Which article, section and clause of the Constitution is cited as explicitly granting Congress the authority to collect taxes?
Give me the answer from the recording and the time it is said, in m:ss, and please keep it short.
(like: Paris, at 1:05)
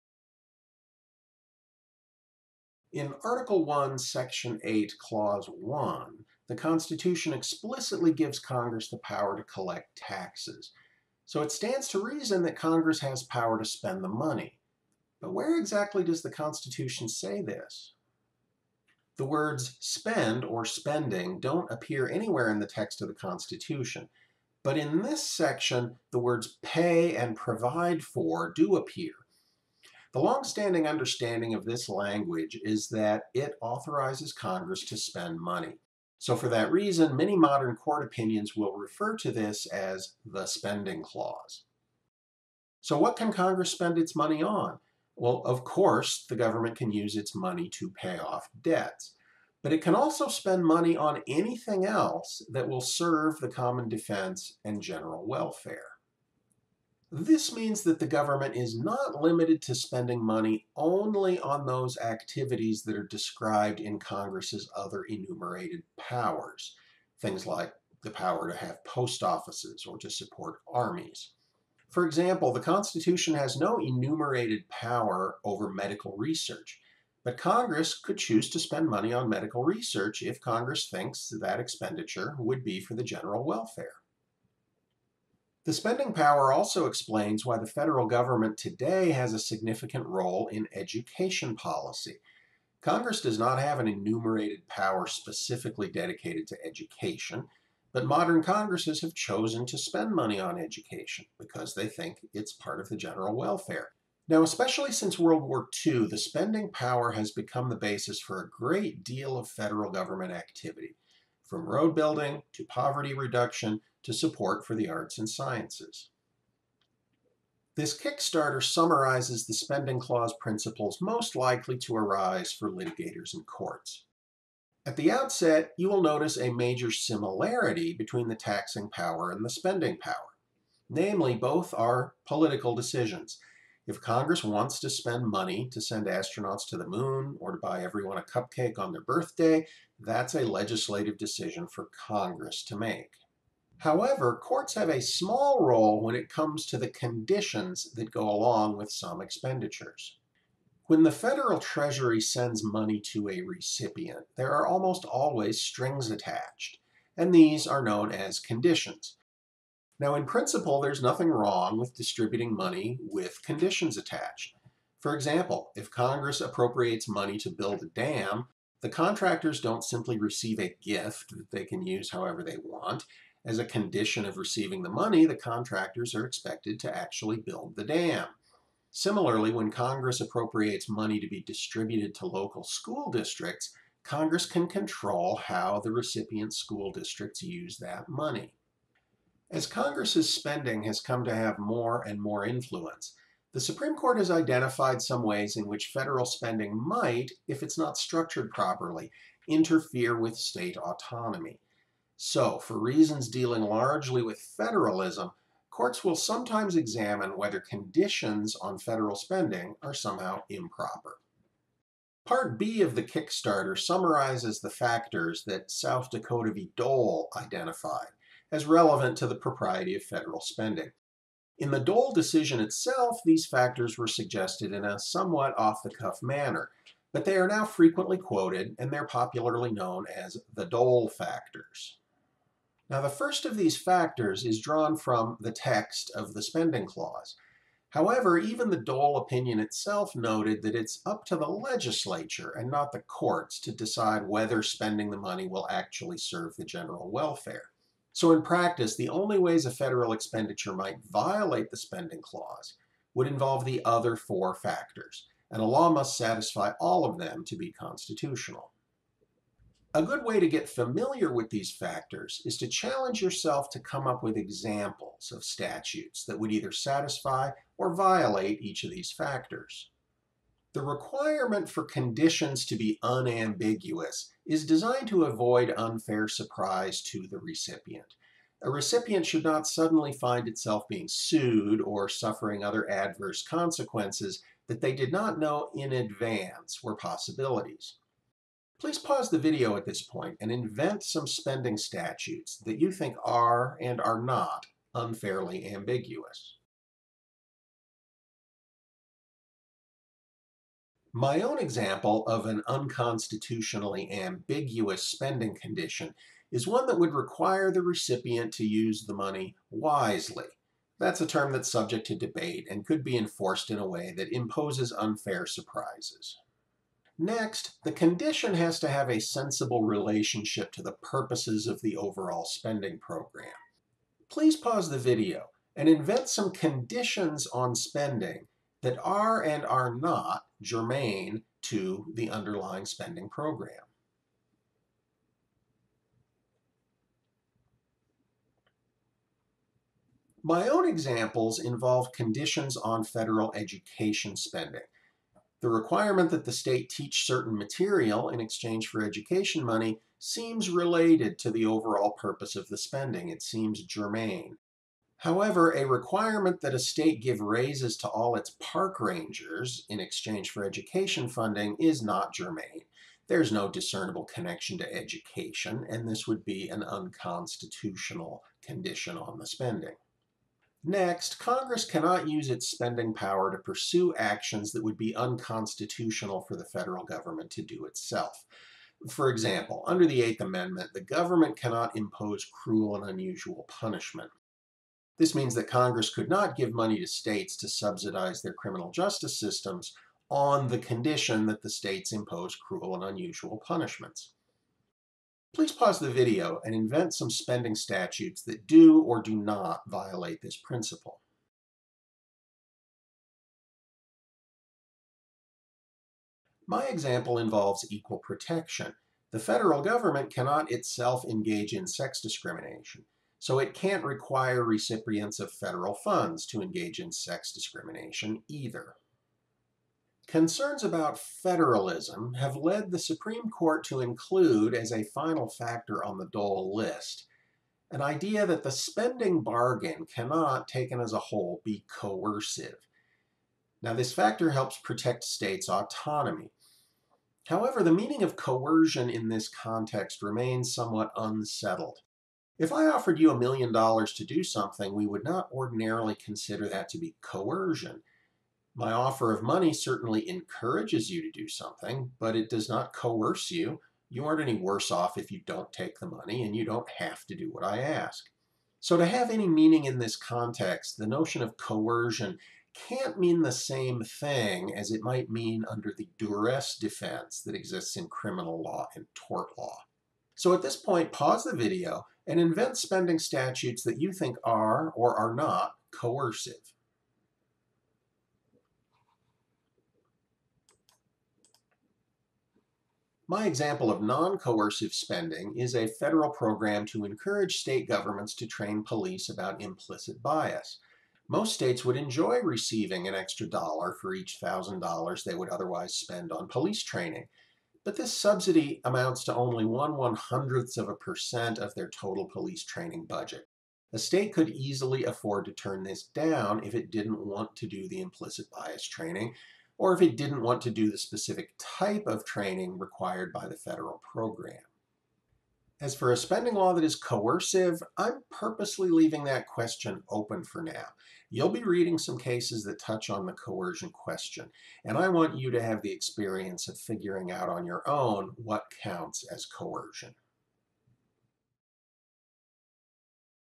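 Article 1, Section 8, Clause 1, at 0:03.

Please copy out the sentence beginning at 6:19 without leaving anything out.
For example, under the Eighth Amendment, the government cannot impose cruel and unusual punishment.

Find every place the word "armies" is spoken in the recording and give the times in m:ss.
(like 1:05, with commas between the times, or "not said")
1:10.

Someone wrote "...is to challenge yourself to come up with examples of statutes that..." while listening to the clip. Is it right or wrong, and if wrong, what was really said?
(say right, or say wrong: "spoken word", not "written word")
right.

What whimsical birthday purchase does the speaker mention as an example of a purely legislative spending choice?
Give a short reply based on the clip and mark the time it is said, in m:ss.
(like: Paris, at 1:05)
A cupcake, at 2:18.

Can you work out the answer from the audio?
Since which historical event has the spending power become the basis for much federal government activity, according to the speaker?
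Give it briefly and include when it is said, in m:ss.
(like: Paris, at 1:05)
World War II, at 1:45.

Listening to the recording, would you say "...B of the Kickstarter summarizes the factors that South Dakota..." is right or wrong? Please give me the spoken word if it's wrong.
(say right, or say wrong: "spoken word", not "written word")
right.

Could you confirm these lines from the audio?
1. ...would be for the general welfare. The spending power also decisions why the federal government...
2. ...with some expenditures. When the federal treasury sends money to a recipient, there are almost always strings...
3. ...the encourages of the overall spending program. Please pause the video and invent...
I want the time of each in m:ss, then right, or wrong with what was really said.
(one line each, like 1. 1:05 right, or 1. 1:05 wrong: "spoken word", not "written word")
1. 1:22 wrong: "explains", not "decisions"
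2. 2:28 right
3. 5:20 wrong: "purposes", not "encourages".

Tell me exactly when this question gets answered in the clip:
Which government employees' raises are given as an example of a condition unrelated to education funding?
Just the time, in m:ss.
5:58.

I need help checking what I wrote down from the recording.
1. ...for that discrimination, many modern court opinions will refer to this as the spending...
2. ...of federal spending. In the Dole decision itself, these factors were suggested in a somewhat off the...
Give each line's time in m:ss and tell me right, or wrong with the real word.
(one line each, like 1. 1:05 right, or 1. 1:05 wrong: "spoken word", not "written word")
1. 0:36 wrong: "reason", not "discrimination"
2. 3:39 right.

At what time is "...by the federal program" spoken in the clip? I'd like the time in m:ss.
8:33.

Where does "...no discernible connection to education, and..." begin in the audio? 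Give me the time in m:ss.
6:03.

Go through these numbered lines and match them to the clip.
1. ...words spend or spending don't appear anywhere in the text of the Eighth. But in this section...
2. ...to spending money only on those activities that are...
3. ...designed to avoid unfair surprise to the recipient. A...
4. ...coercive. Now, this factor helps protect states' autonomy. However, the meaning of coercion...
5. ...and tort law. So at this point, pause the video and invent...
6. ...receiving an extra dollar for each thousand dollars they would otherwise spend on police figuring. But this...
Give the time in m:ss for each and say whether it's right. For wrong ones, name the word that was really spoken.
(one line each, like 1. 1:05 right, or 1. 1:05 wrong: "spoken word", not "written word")
1. 0:19 wrong: "Constitution", not "Eighth"
2. 0:59 right
3. 4:34 right
4. 7:11 right
5. 7:48 right
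6. 8:12 wrong: "training", not "figuring".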